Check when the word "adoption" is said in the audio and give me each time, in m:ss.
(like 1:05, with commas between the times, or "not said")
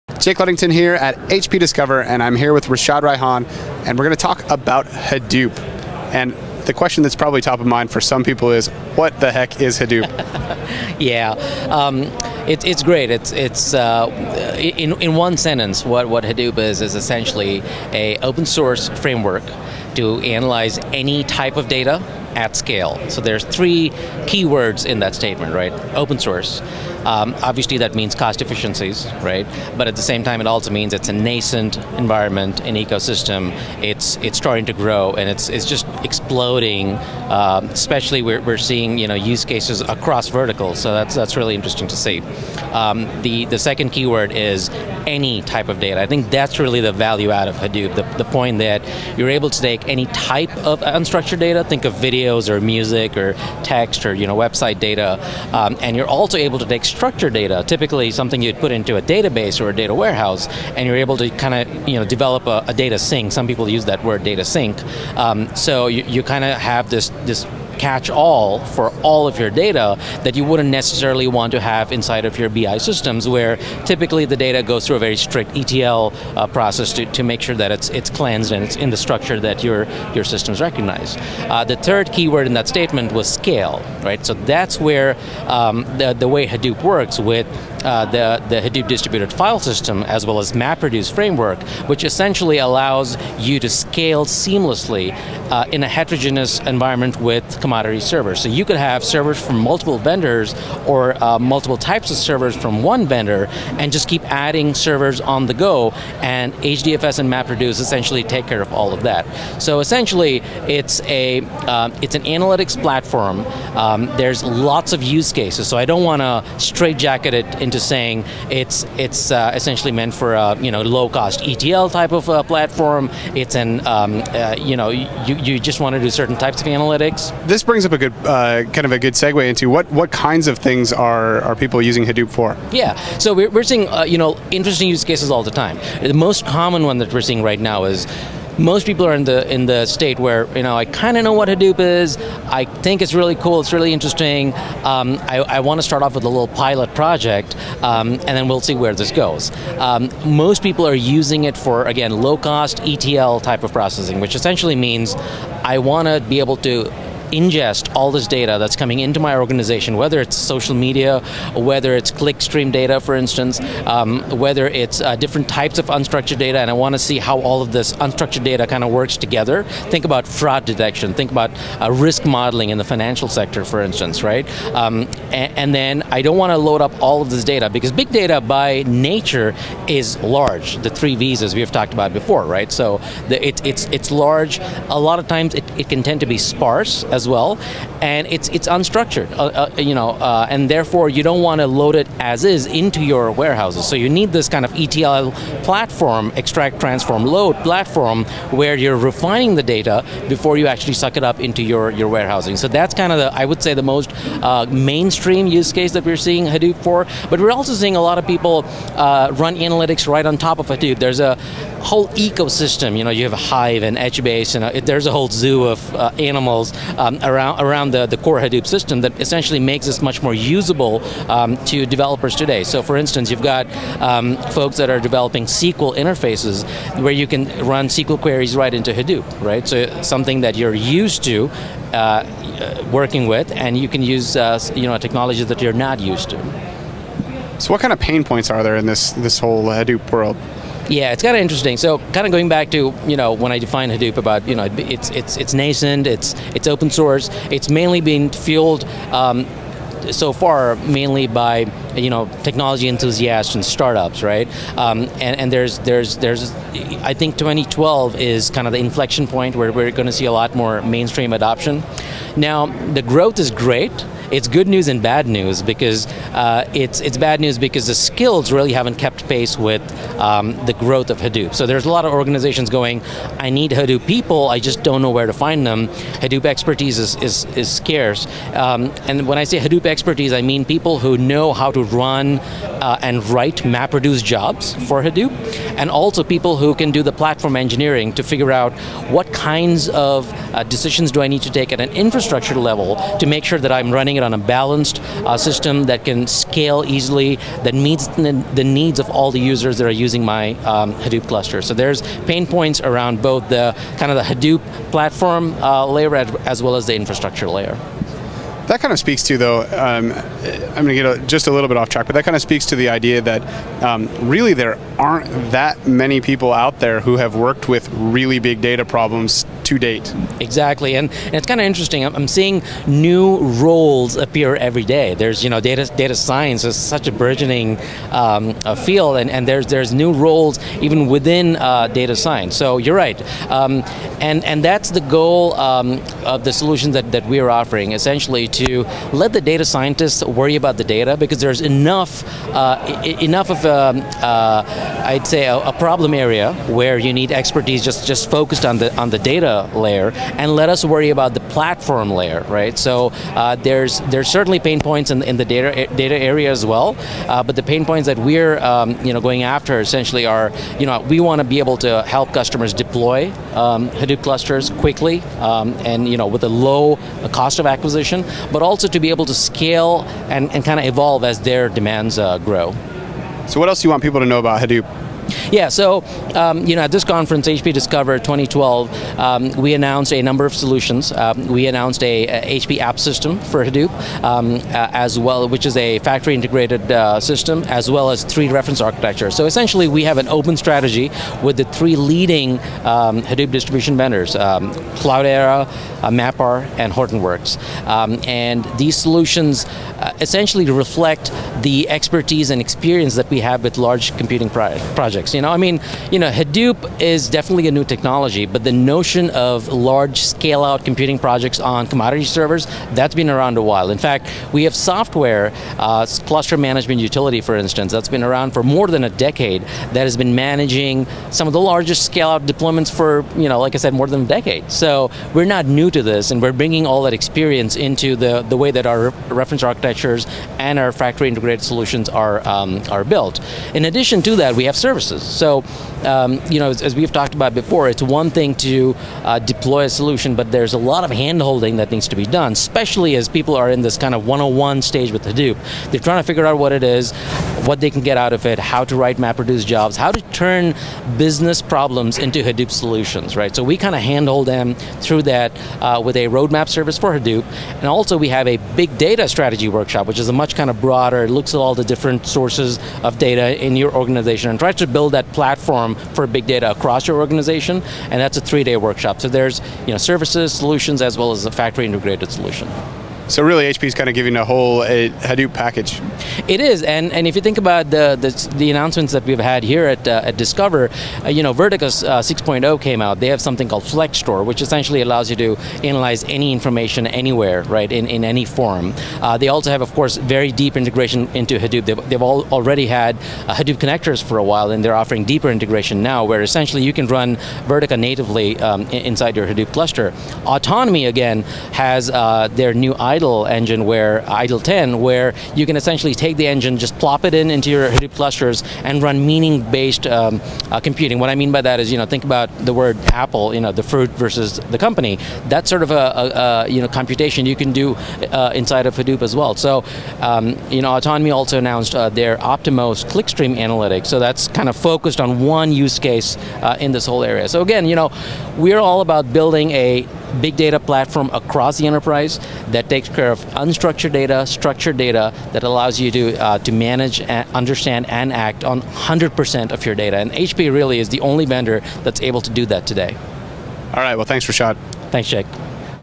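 4:21.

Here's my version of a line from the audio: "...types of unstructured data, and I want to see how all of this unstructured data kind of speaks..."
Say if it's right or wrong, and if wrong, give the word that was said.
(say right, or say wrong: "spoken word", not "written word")
wrong: "works", not "speaks".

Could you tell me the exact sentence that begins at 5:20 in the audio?
Exactly, and, and it's kind of interesting.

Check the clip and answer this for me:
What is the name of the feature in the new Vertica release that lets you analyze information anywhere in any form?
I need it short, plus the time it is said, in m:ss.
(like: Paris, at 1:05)
FlexStore, at 8:03.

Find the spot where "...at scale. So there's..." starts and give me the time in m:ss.
0:22.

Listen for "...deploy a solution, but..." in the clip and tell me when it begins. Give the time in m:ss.
7:19.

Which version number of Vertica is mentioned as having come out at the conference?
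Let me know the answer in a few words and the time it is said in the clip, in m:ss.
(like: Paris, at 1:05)
6.0, at 8:02.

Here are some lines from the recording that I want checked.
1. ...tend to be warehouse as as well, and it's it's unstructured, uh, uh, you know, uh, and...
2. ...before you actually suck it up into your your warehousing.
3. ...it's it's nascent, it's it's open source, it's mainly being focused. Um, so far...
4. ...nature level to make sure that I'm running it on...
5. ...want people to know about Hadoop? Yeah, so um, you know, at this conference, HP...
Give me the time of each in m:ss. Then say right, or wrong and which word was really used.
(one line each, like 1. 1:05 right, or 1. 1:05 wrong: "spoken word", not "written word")
1. 3:06 wrong: "sparse", not "warehouse"
2. 3:20 right
3. 4:05 wrong: "fueled", not "focused"
4. 4:51 wrong: "infrastructure", not "nature"
5. 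6:13 right.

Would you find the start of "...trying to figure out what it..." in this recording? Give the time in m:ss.
7:25.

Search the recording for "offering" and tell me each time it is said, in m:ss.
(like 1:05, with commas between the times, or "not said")
5:37, 8:15.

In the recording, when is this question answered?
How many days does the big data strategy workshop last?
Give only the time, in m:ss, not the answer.
7:48.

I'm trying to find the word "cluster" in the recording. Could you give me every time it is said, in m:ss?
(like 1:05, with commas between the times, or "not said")
5:01, 6:04, 6:56, 8:19, 8:28.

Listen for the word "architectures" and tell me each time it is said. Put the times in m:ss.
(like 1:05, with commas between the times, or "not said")
6:28, 7:09.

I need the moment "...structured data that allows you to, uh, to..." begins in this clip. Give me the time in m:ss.
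8:54.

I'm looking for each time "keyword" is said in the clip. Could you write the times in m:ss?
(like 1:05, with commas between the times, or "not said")
0:43, 1:22.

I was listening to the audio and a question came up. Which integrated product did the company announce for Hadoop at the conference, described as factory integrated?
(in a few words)
HP App System for Hadoop.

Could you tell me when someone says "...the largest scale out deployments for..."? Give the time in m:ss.
7:01.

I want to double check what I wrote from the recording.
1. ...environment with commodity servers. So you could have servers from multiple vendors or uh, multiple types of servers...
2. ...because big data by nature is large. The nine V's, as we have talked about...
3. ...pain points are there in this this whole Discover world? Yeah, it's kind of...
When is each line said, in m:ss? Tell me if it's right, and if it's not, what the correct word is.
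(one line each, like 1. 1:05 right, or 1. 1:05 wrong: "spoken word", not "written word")
1. 1:36 right
2. 2:57 wrong: "three", not "nine"
3. 3:57 wrong: "Hadoop", not "Discover".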